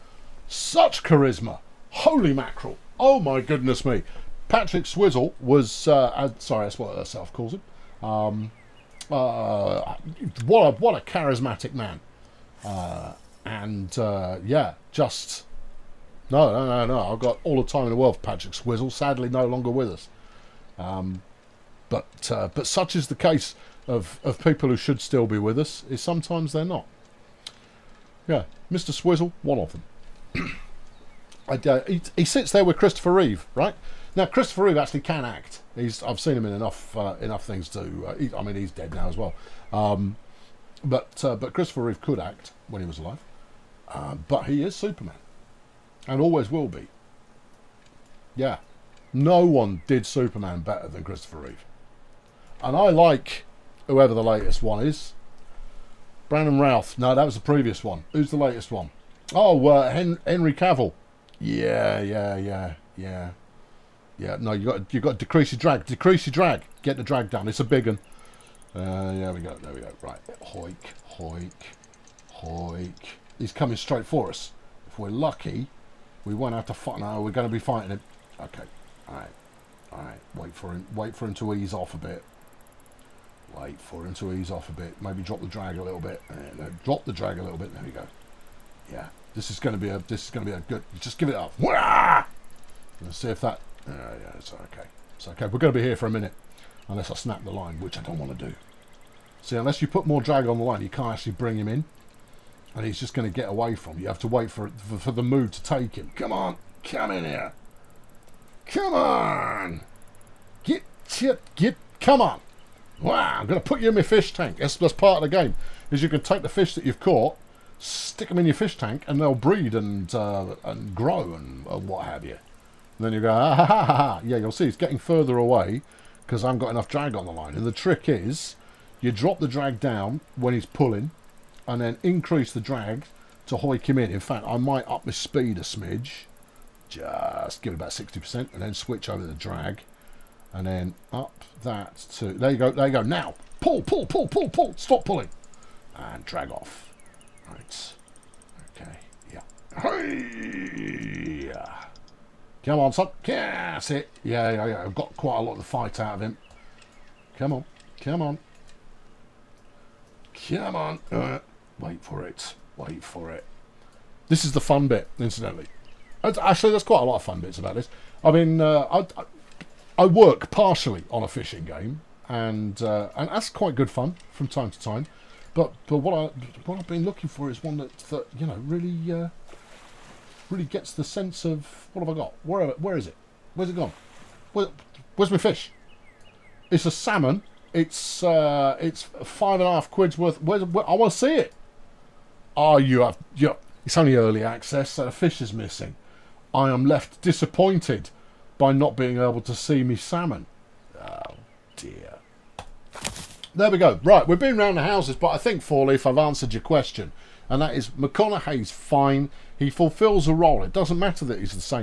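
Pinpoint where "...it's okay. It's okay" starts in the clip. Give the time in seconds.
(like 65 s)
94 s.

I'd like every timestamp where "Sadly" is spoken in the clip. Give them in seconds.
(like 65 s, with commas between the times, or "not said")
18 s.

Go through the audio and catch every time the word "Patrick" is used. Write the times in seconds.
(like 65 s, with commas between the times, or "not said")
4 s, 18 s.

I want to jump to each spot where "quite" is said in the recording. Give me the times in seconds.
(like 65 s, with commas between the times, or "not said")
155 s, 166 s, 173 s.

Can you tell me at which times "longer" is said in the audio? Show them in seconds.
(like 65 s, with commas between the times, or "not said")
19 s.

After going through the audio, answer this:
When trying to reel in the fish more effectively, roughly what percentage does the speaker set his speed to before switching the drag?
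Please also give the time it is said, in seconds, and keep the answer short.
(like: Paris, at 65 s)
60%, at 137 s.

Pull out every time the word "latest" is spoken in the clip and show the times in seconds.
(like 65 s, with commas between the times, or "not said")
54 s, 58 s.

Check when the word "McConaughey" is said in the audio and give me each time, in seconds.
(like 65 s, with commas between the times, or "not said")
207 s.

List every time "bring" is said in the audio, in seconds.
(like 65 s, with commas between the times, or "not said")
101 s.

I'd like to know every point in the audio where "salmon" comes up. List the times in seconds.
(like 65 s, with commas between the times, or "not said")
186 s, 199 s.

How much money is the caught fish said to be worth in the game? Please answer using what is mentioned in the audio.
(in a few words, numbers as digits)
£5.50.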